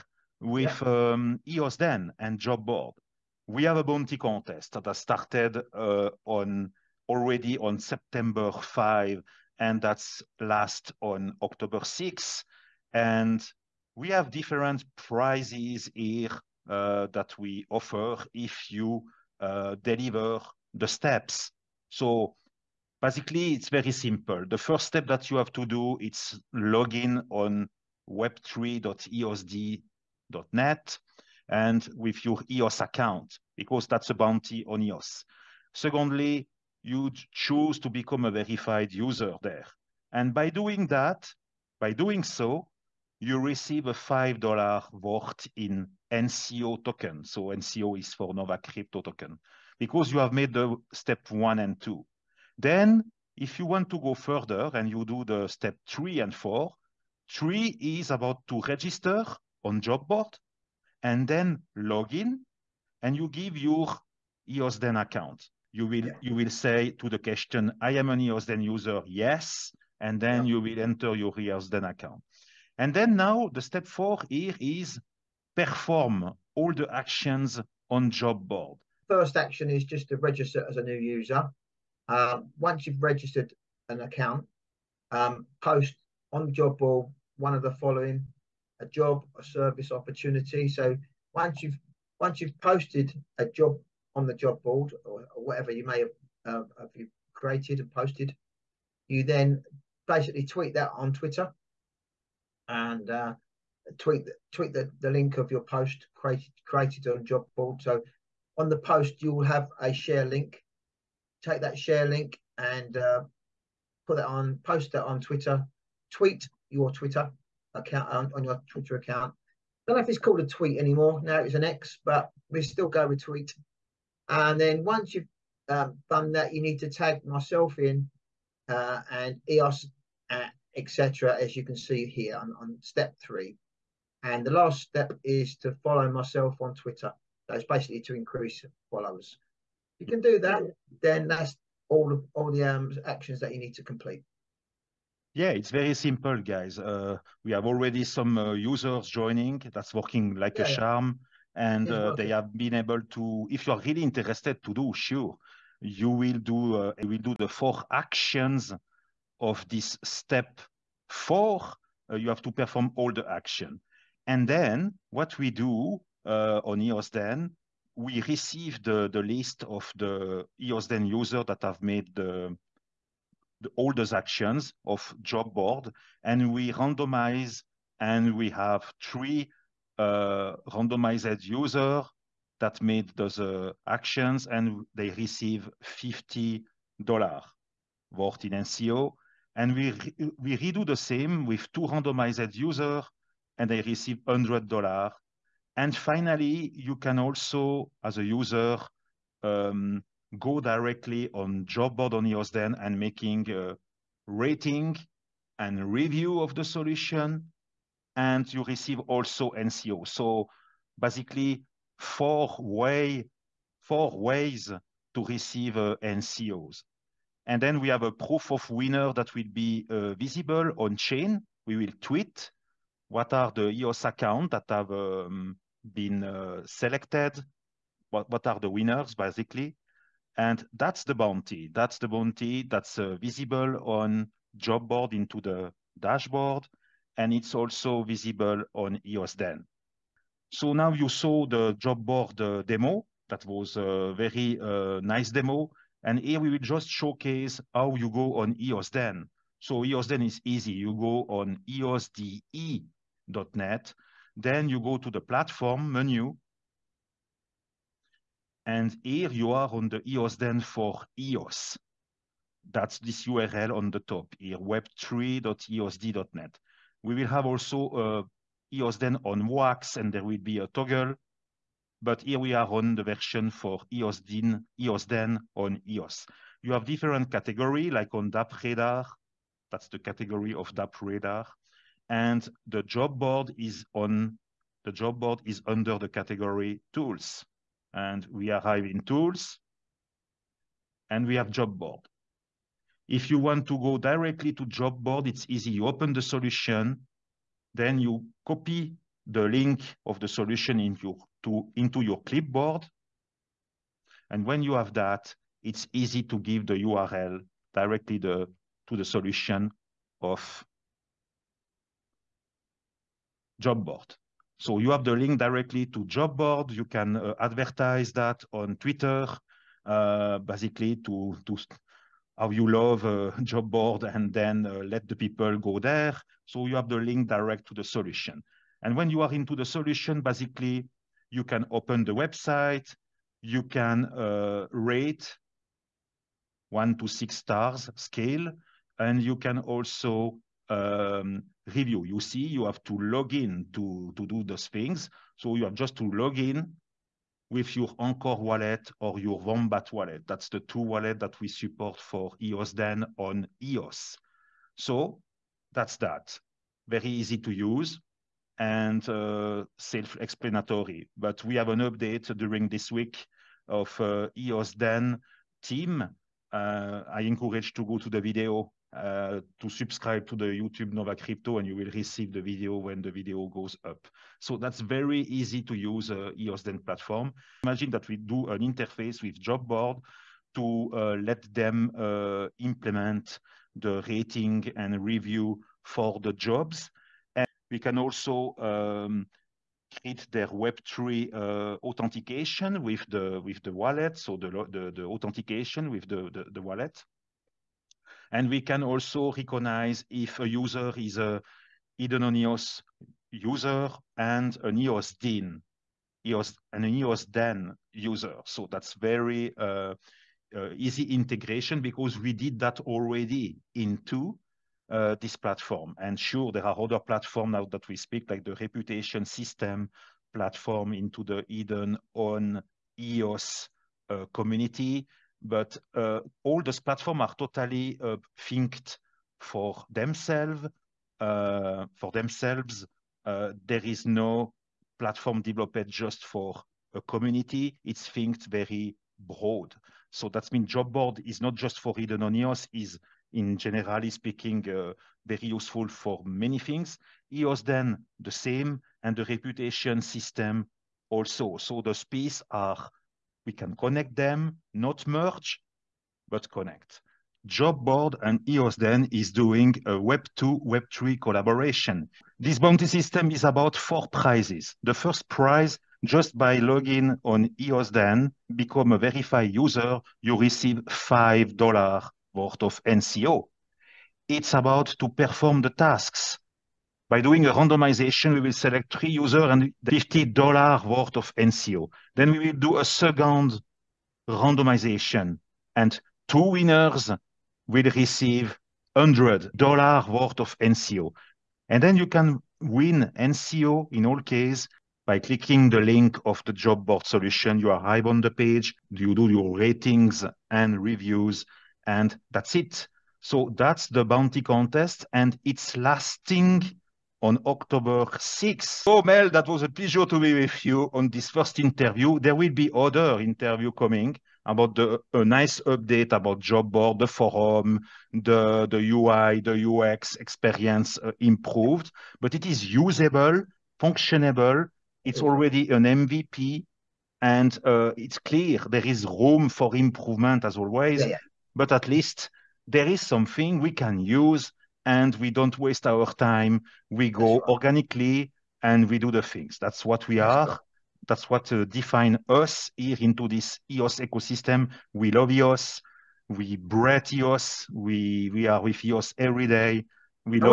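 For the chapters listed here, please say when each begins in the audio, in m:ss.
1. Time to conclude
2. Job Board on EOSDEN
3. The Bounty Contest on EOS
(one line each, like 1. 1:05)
1. 8:28
2. 3:59
3. 7:36.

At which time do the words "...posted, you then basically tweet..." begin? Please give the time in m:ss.
1:37.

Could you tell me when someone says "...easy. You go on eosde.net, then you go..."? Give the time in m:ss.
4:10.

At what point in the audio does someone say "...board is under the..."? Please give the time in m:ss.
4:45.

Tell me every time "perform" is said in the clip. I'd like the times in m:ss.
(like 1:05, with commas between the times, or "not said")
1:15, 2:42, 7:55.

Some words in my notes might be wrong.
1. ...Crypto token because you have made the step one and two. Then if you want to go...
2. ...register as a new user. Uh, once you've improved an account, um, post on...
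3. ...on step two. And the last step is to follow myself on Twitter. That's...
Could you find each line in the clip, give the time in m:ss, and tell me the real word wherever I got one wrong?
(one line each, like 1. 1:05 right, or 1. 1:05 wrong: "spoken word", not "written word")
1. 0:48 right
2. 1:20 wrong: "registered", not "improved"
3. 2:12 wrong: "three", not "two".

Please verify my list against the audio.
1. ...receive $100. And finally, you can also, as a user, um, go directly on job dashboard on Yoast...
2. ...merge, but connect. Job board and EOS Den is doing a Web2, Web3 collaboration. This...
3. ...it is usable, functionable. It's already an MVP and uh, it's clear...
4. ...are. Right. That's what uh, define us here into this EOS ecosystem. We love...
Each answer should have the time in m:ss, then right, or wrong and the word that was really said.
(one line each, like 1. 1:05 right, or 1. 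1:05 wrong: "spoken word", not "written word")
1. 3:13 wrong: "board", not "dashboard"
2. 7:35 right
3. 8:42 right
4. 9:00 right.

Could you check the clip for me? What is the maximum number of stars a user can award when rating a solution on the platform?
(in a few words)
6.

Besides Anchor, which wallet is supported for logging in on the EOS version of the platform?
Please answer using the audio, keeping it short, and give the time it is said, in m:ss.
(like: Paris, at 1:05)
Wombat, at 5:49.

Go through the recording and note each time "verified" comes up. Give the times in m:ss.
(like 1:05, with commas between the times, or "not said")
0:38, 7:48.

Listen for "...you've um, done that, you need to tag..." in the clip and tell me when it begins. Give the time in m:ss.
2:05.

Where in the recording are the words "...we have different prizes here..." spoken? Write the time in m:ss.
0:13.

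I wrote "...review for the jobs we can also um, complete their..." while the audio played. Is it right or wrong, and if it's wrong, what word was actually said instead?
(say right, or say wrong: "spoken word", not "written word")
wrong: "create", not "complete".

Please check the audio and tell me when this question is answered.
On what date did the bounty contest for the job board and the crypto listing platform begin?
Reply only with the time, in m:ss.
0:07.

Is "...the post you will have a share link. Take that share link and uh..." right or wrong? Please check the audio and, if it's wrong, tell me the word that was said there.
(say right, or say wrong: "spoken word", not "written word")
right.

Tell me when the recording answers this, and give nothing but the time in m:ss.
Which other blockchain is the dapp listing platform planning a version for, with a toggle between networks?
4:29.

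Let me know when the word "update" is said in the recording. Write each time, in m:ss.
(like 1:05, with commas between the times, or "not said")
6:01, 8:35.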